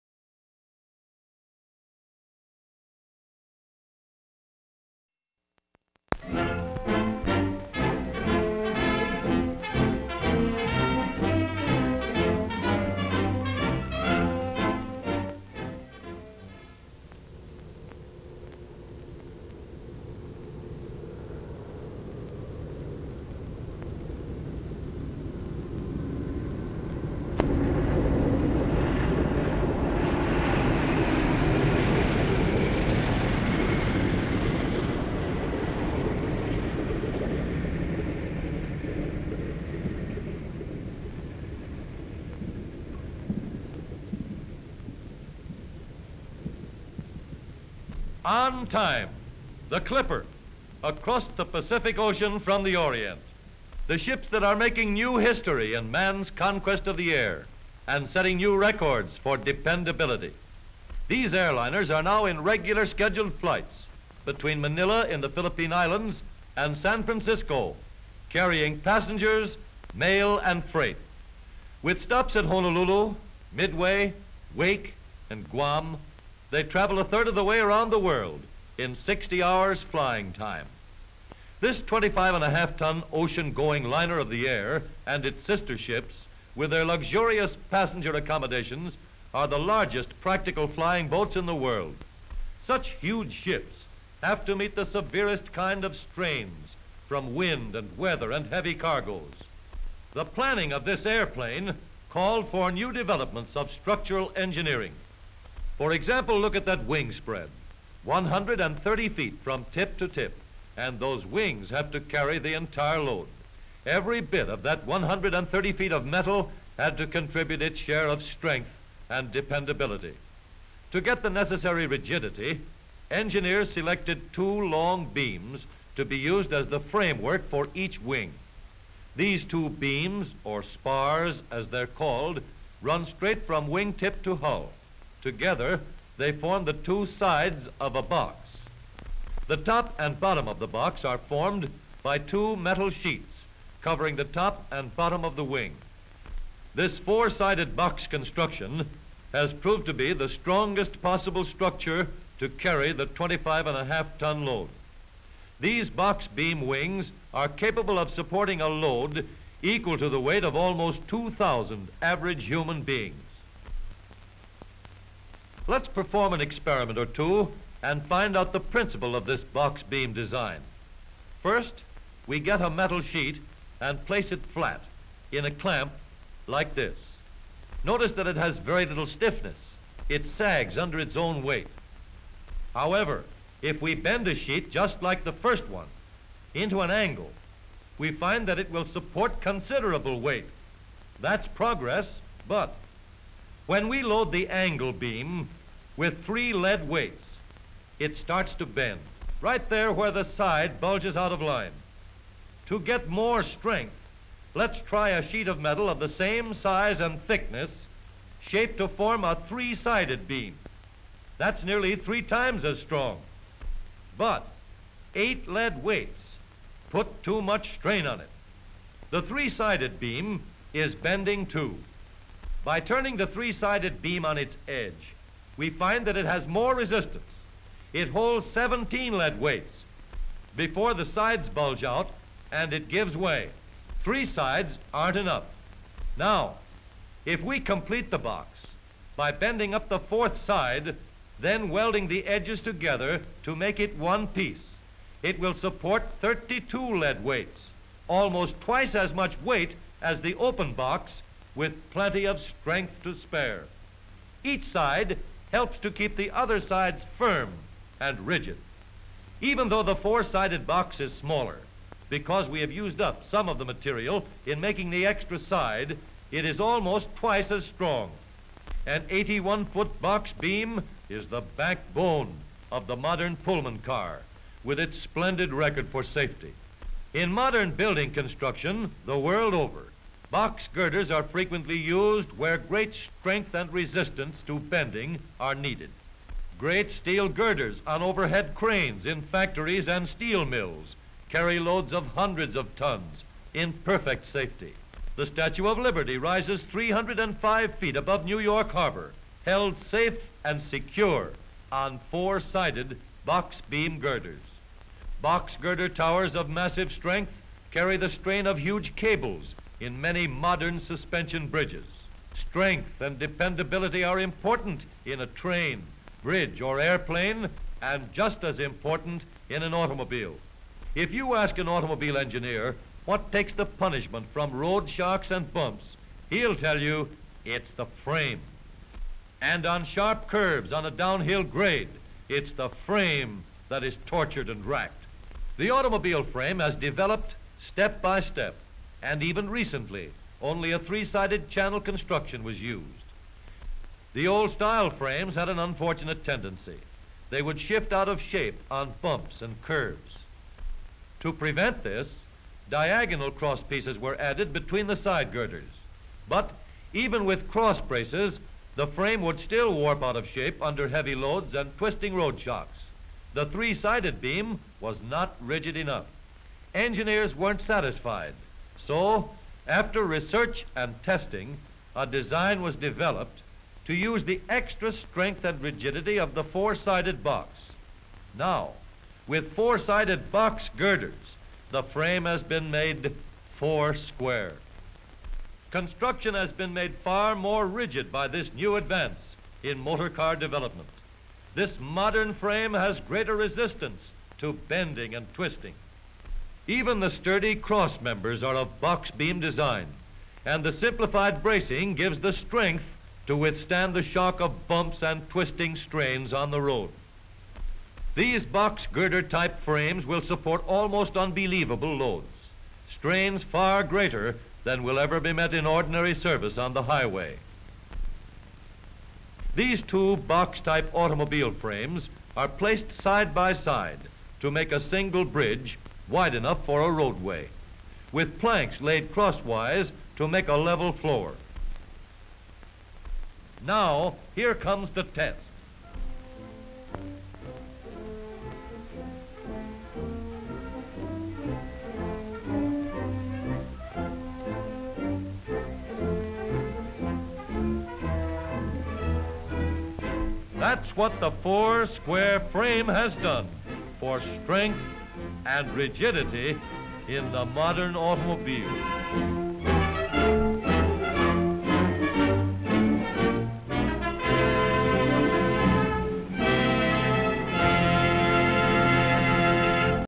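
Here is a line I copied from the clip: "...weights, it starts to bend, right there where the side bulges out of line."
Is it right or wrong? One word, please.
right.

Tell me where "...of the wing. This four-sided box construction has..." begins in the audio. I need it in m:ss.
2:25.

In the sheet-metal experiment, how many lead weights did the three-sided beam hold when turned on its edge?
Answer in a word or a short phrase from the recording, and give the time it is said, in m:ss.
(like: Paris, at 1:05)
17, at 3:48.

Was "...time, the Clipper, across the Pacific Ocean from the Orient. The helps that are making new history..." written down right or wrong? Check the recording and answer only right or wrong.
wrong.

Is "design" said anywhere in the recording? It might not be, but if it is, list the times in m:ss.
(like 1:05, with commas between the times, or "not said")
2:50, 6:12, 6:39.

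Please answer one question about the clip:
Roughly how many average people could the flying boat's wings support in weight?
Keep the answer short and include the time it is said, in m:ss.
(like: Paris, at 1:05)
almost 2,000, at 2:40.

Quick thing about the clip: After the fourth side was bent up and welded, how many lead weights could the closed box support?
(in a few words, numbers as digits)
32.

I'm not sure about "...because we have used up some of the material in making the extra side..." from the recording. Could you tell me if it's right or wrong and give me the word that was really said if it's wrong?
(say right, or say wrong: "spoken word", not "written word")
right.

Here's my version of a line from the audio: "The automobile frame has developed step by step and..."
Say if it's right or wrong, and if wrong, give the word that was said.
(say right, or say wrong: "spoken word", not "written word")
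right.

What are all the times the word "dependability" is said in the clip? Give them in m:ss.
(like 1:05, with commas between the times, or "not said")
0:59, 1:59, 5:13.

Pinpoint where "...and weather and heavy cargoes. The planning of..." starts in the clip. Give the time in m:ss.
1:37.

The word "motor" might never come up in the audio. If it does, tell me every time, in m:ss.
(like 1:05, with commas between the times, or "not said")
6:29.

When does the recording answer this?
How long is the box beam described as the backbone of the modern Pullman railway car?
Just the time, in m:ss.
4:29.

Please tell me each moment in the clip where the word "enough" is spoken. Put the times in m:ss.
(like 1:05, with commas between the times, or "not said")
3:55, 6:05, 7:06.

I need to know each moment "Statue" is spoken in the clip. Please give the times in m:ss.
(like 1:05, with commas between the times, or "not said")
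4:55.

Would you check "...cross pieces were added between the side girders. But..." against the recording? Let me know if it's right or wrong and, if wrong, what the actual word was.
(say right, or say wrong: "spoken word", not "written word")
right.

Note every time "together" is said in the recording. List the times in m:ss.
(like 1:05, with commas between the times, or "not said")
2:15, 4:02.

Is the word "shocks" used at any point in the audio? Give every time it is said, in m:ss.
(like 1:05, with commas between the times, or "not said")
5:24, 6:02, 6:44.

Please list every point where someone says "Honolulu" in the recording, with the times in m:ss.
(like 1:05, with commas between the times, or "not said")
1:12.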